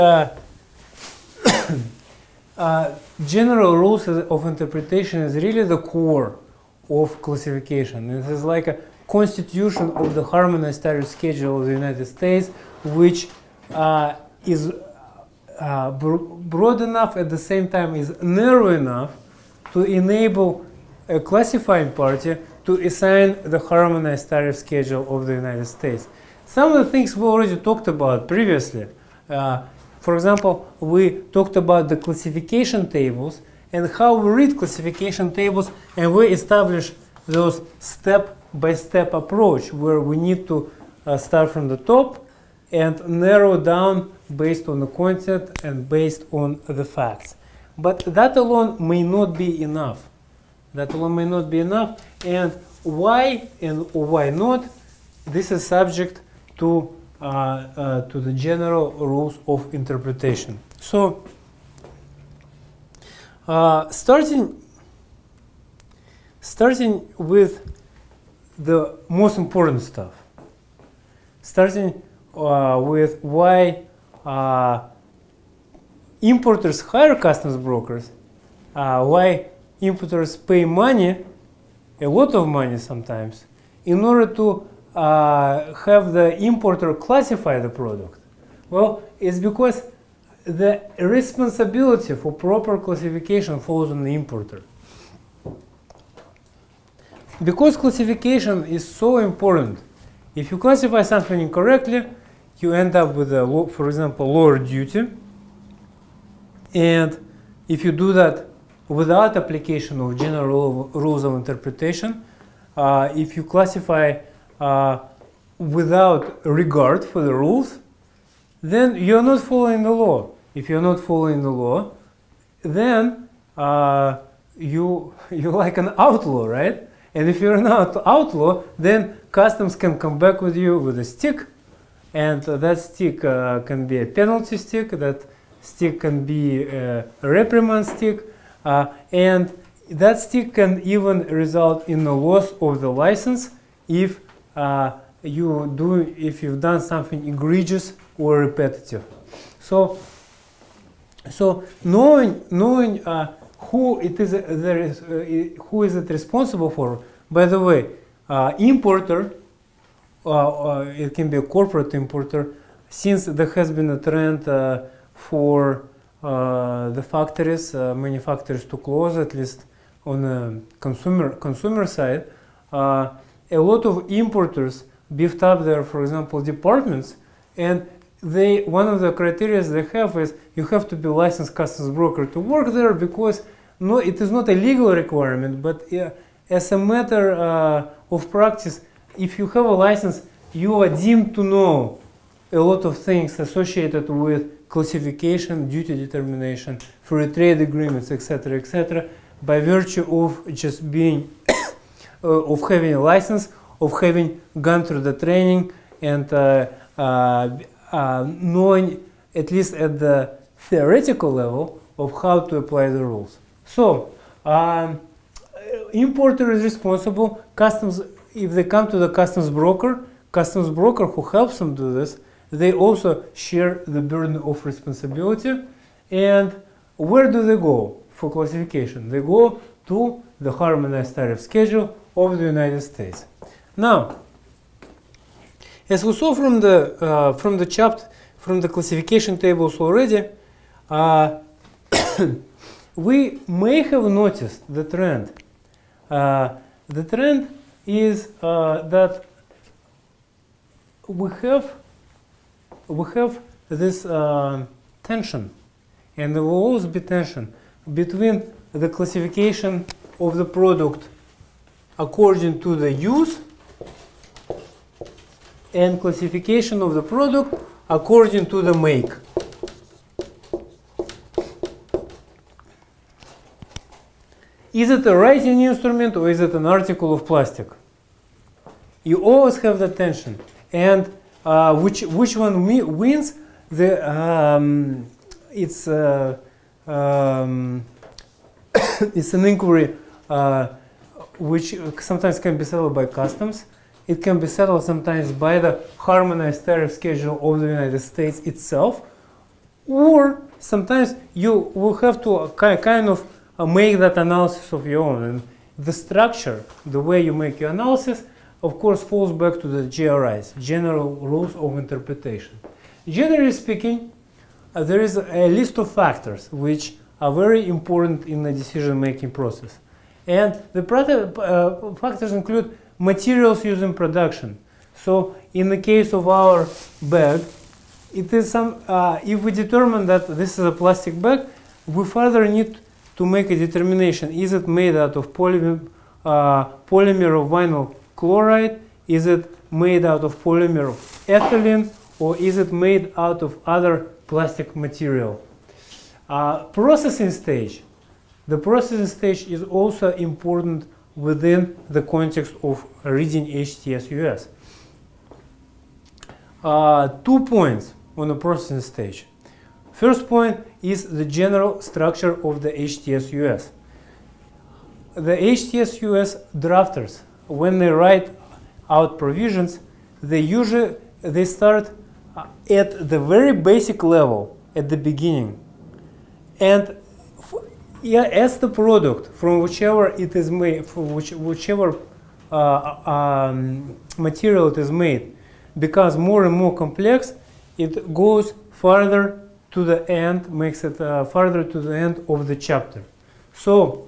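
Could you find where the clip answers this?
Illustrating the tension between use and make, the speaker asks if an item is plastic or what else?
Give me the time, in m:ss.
4:35.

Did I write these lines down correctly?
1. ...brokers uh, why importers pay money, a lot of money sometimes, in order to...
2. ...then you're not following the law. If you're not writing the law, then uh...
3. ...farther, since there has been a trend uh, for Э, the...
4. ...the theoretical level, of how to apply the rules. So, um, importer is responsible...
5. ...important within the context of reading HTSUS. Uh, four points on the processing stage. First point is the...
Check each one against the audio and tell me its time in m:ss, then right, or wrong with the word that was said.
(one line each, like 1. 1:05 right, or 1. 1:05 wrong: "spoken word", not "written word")
1. 1:17 right
2. 1:58 wrong: "following", not "writing"
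3. 2:41 wrong: "importer", not "farther"
4. 3:29 right
5. 5:50 wrong: "two", not "four".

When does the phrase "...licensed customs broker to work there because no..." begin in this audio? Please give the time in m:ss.
3:01.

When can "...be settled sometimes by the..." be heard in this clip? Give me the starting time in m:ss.
4:54.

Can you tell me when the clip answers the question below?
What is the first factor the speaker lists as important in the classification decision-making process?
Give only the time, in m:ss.
5:22.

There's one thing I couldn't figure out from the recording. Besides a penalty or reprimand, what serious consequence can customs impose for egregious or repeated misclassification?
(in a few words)
loss of the license.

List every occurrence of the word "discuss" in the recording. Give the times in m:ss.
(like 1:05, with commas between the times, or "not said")
not said.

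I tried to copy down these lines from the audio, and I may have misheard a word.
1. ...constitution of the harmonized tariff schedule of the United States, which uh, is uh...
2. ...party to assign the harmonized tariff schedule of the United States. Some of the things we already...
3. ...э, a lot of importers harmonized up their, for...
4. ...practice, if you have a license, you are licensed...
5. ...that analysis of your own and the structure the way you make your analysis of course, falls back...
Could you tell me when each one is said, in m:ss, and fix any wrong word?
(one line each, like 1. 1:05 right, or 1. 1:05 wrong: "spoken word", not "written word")
1. 0:09 right
2. 0:21 right
3. 2:52 wrong: "beefed", not "harmonized"
4. 3:08 wrong: "deemed", not "licensed"
5. 5:03 right.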